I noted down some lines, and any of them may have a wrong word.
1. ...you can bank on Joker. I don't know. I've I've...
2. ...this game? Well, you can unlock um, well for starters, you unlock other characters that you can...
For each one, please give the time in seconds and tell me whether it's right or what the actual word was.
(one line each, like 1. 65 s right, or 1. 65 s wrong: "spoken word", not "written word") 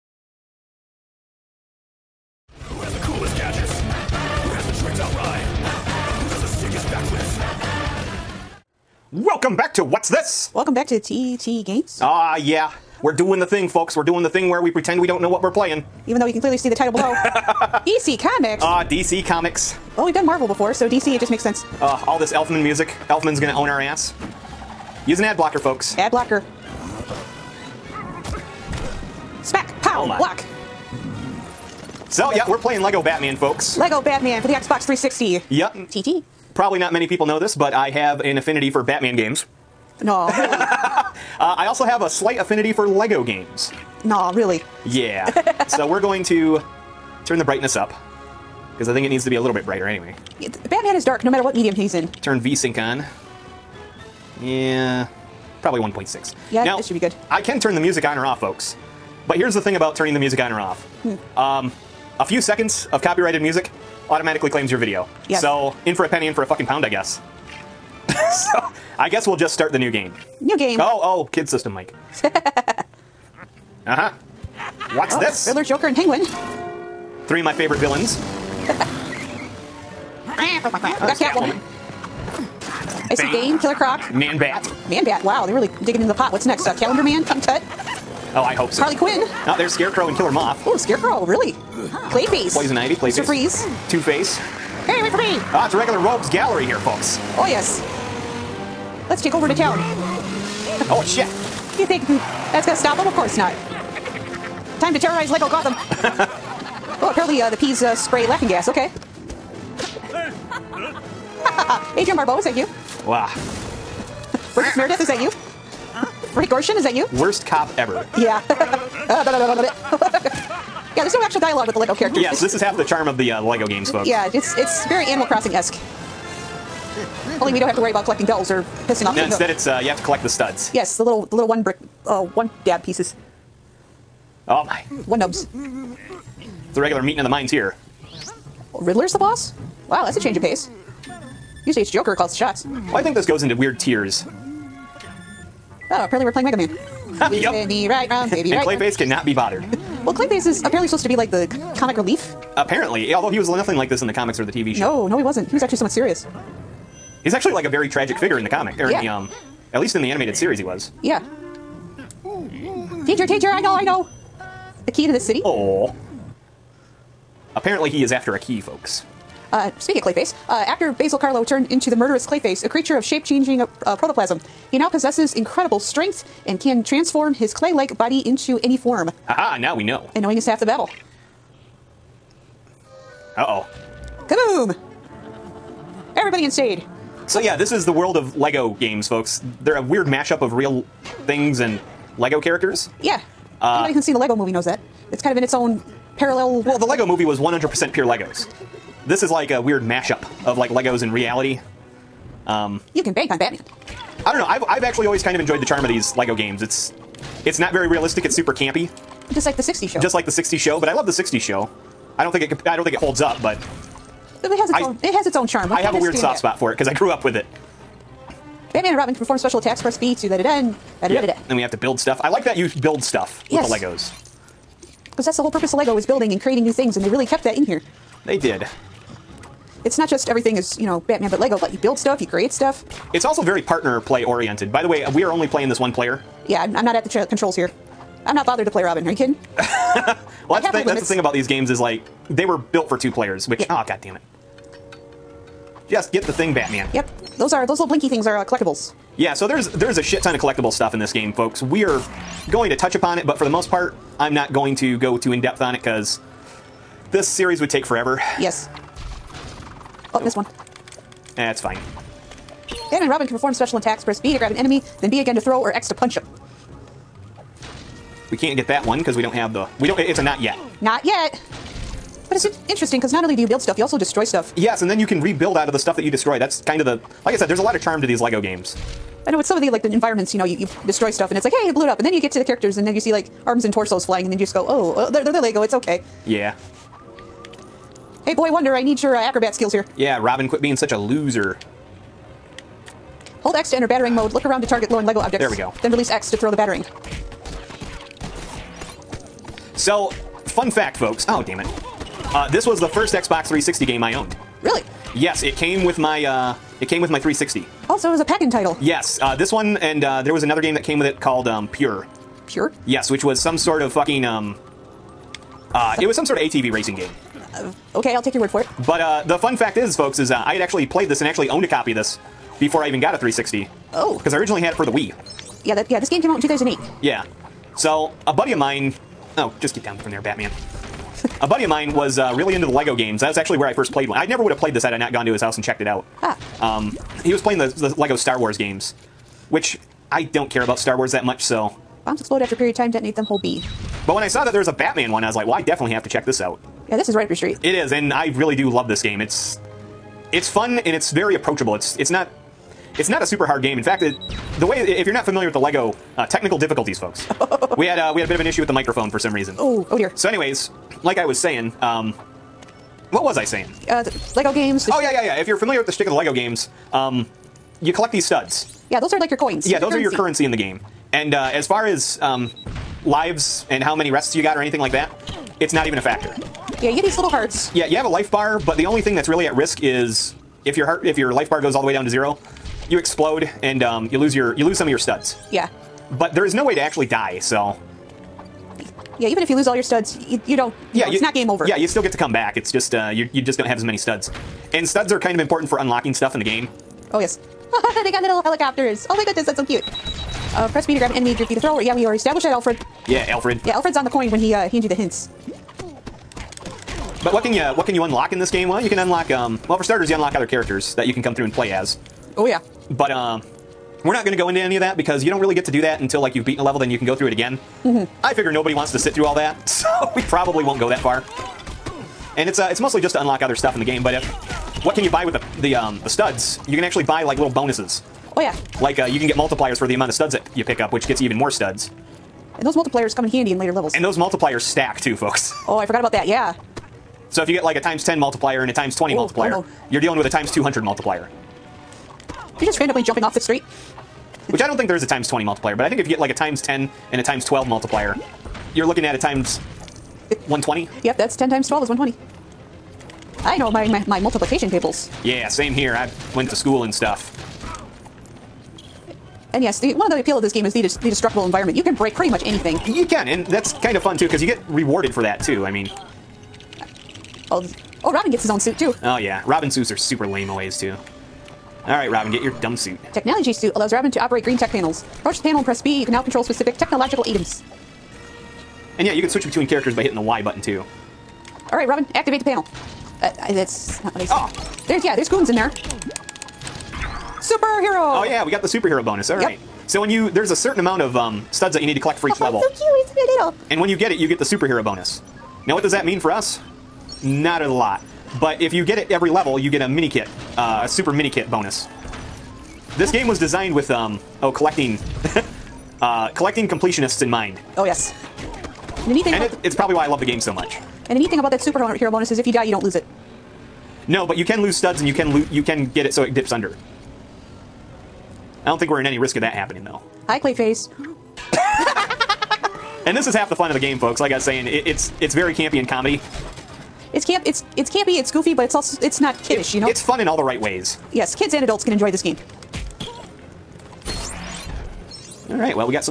1. 202 s wrong: "Batman", not "Joker"
2. 408 s right.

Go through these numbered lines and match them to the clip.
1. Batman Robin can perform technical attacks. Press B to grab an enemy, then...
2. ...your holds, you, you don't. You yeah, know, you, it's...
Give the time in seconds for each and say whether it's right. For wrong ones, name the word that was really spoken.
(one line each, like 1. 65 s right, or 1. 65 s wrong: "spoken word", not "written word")
1. 262 s wrong: "special", not "technical"
2. 389 s wrong: "studs", not "holds".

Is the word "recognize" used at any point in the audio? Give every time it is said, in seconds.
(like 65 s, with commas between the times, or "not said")
not said.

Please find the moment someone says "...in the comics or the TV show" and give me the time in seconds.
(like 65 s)
154 s.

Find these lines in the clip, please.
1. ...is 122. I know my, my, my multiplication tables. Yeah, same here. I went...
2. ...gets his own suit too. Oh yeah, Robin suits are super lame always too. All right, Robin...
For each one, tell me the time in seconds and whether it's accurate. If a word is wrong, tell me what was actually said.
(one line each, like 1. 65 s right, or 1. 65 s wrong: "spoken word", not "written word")
1. 451 s wrong: "120", not "122"
2. 468 s right.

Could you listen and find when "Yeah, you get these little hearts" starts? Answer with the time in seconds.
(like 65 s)
376 s.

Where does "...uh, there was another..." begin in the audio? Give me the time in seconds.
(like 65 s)
310 s.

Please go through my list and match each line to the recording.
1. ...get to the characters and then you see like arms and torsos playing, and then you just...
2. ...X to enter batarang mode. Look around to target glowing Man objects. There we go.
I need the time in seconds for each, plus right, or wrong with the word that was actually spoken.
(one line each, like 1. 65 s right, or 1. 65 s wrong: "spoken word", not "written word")
1. 282 s wrong: "flying", not "playing"
2. 293 s wrong: "Lego", not "Man".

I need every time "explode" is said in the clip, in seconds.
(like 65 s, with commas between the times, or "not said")
342 s, 382 s.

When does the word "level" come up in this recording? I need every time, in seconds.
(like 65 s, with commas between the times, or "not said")
416 s, 433 s, 492 s, 499 s.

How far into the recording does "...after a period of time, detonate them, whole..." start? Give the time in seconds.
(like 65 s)
342 s.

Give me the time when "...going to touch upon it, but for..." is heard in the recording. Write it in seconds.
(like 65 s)
252 s.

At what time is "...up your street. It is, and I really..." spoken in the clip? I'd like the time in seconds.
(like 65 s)
347 s.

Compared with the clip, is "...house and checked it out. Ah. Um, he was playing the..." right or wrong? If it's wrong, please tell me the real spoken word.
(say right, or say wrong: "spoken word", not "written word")
right.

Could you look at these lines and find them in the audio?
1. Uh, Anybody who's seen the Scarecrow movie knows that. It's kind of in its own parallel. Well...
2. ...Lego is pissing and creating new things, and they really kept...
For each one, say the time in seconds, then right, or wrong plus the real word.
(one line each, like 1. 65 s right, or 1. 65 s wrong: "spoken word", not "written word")
1. 193 s wrong: "Lego", not "Scarecrow"
2. 225 s wrong: "building", not "pissing".